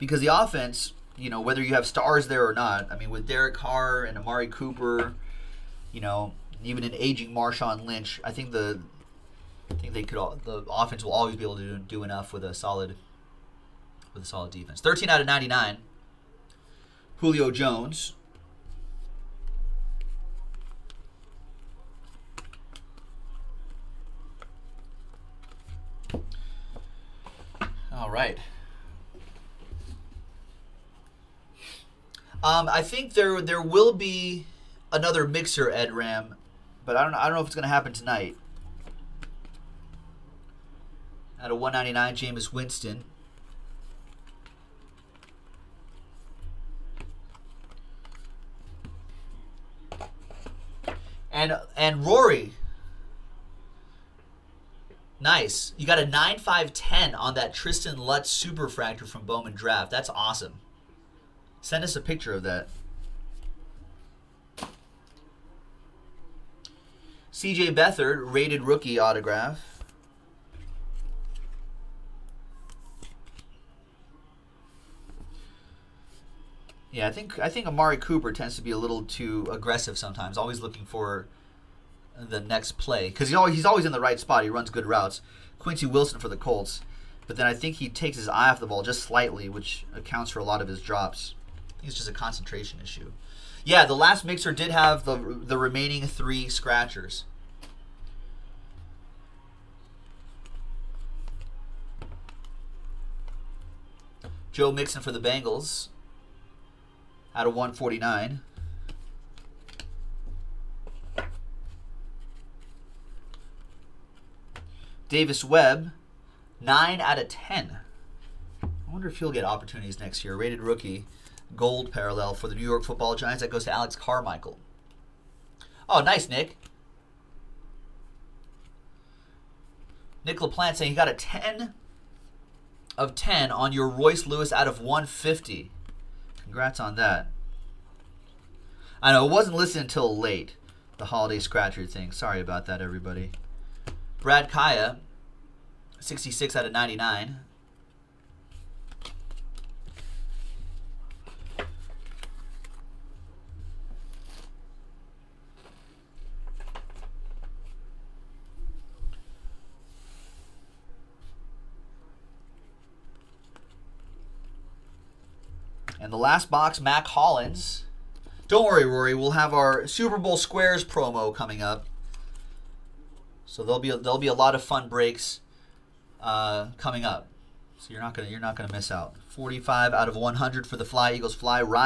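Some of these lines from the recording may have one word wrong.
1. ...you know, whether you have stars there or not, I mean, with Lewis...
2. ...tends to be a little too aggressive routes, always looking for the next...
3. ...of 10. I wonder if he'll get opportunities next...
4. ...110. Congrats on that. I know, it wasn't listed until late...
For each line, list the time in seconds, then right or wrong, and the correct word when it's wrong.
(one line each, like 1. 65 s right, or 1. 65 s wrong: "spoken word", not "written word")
1. 1 s wrong: "Derek", not "Lewis"
2. 78 s wrong: "sometimes", not "routes"
3. 117 s right
4. 134 s wrong: "150", not "110".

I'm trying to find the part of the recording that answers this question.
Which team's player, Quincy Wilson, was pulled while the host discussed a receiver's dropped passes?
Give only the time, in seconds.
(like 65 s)
86 s.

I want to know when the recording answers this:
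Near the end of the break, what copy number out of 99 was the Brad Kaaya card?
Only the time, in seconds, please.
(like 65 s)
145 s.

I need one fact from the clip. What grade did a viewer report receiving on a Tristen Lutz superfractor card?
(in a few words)
9.5/10.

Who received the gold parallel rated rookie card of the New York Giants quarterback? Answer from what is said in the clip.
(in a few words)
Alex Carmichael.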